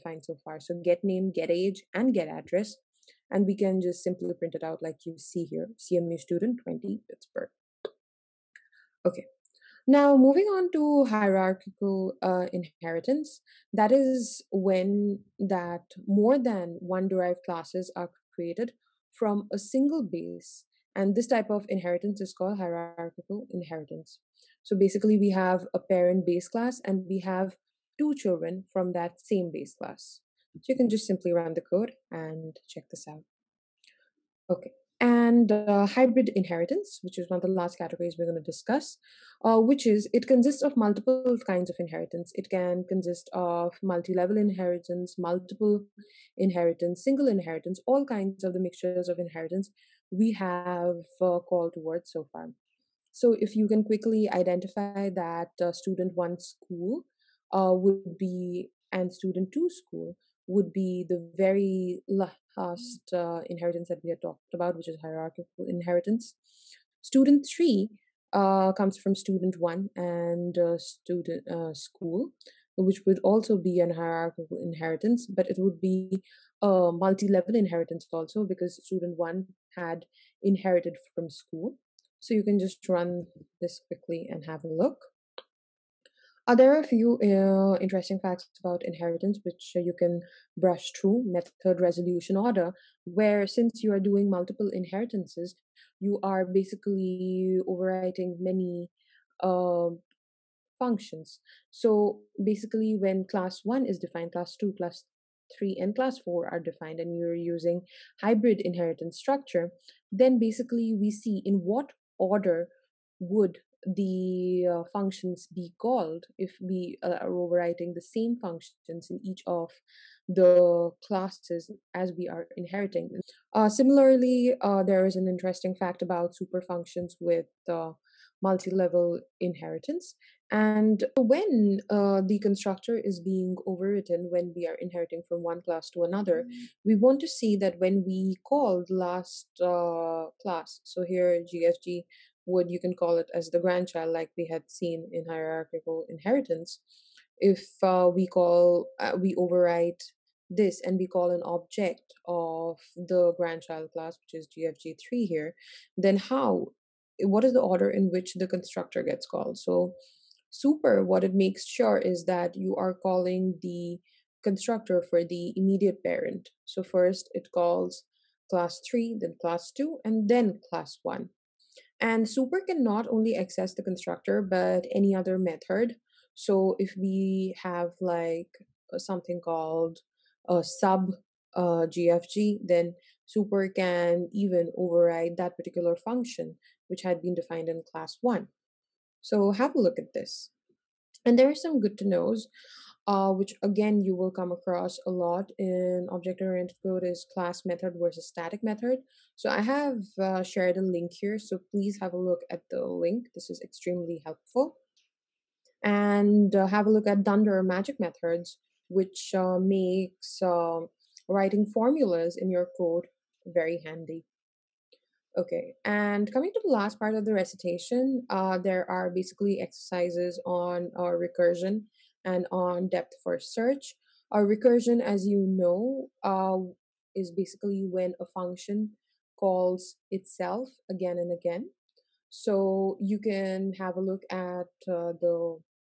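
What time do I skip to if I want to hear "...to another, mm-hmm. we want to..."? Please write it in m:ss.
2:15.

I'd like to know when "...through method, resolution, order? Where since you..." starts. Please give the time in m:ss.
1:30.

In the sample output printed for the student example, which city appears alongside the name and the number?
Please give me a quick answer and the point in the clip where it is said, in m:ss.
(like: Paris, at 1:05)
Pittsburgh, at 0:07.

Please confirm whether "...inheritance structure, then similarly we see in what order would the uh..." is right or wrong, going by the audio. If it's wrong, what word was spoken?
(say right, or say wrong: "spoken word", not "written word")
wrong: "basically", not "similarly".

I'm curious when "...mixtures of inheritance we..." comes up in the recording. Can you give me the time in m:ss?
0:48.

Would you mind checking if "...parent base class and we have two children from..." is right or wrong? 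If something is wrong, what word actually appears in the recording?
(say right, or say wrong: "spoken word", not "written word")
right.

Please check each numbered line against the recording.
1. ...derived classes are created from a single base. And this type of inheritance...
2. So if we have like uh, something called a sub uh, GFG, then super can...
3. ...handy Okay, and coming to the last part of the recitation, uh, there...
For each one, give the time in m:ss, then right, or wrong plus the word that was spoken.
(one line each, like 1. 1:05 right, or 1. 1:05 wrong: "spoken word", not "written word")
1. 0:17 right
2. 2:56 right
3. 3:33 right.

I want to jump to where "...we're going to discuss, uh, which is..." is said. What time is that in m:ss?
0:38.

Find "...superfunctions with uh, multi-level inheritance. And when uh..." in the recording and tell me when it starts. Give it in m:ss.
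2:06.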